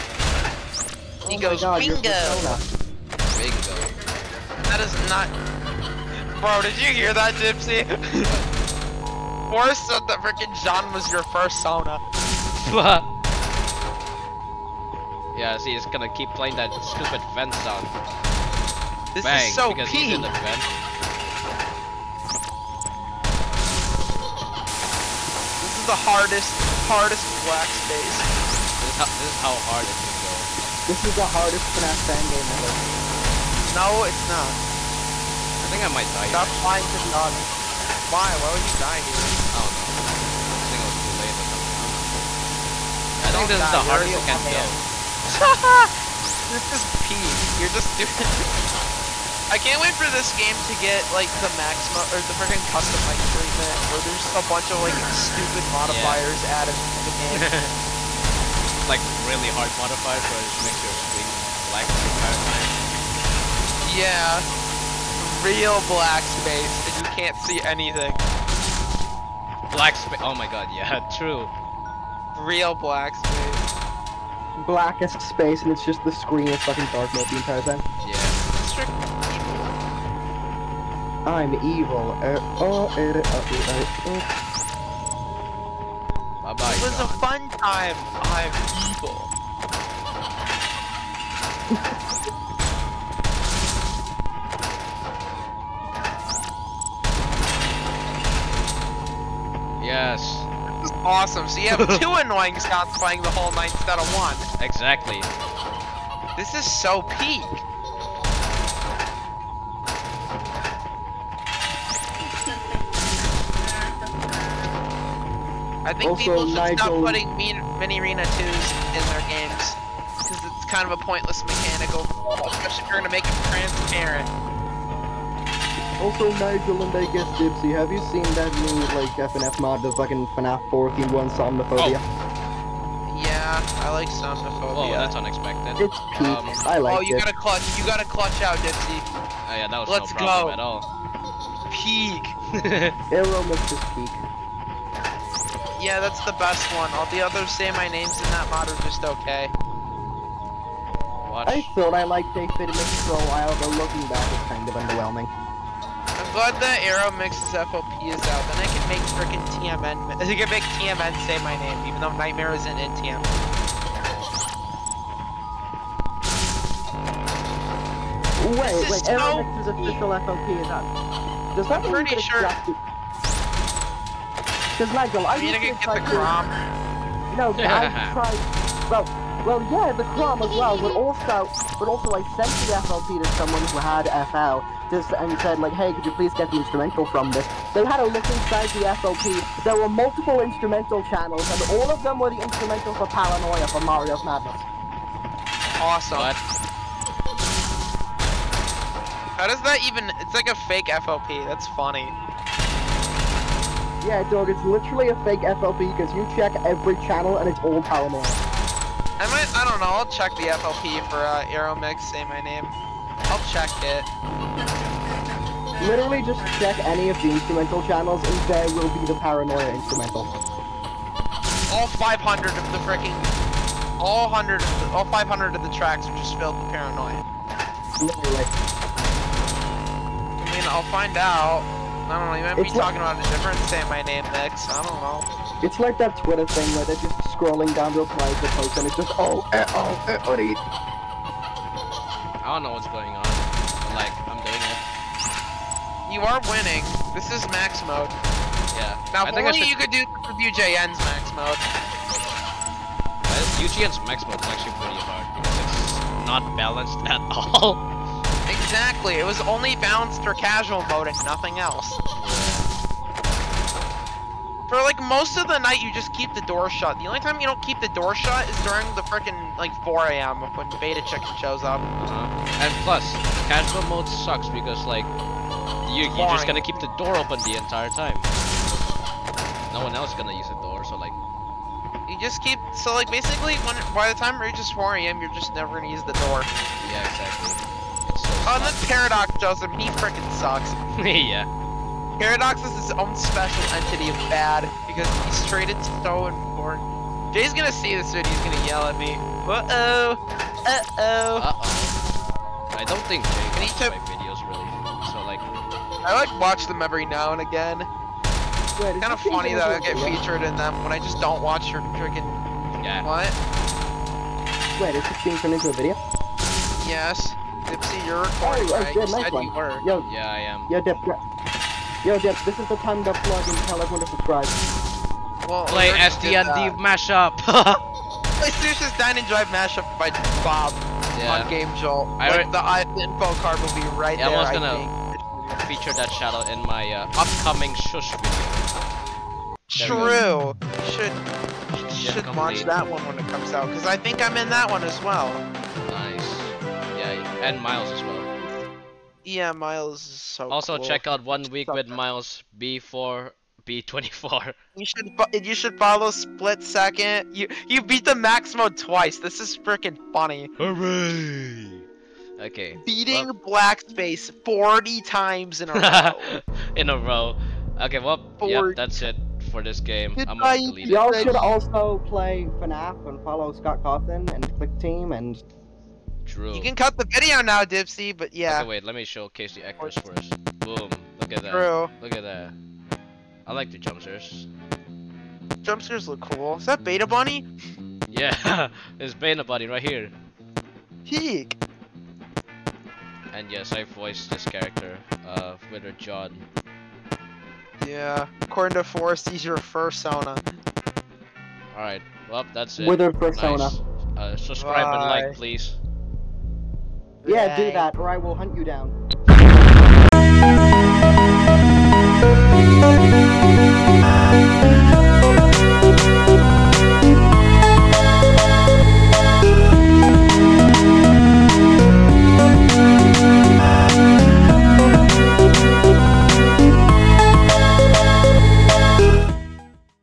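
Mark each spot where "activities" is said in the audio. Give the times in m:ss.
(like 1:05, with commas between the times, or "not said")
not said.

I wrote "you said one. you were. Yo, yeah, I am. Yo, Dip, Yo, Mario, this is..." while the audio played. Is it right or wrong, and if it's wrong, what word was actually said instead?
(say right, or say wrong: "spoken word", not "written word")
wrong: "Jeff", not "Mario".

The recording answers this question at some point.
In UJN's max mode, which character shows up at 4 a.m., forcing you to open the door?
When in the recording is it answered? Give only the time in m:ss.
4:30.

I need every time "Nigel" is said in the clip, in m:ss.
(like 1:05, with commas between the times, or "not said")
2:06, 2:54.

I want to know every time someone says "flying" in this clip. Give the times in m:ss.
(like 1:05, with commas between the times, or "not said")
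0:36.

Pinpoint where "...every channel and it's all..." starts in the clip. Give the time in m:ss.
3:26.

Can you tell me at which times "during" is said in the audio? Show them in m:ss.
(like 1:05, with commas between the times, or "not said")
4:28.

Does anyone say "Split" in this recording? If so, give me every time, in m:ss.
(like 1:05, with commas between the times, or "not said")
5:56.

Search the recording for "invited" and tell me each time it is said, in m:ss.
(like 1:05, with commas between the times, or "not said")
not said.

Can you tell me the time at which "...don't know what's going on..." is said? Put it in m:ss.
4:02.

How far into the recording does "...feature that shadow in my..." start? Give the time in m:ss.
5:35.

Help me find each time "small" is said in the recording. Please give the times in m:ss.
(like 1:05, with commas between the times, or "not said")
not said.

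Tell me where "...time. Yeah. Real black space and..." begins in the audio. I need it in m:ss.
1:03.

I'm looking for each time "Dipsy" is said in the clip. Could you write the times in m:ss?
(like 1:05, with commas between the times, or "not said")
2:07, 2:18, 5:17, 6:17.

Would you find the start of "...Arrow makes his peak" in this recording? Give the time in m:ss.
2:23.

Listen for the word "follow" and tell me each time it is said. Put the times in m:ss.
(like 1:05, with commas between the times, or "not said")
5:55, 6:13.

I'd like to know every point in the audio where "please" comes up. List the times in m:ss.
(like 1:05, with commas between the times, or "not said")
3:06, 6:45.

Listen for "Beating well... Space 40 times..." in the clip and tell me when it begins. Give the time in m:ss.
6:02.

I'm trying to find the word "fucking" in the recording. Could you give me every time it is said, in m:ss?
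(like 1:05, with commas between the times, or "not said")
1:16, 2:09.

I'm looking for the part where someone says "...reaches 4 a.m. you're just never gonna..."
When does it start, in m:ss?
4:44.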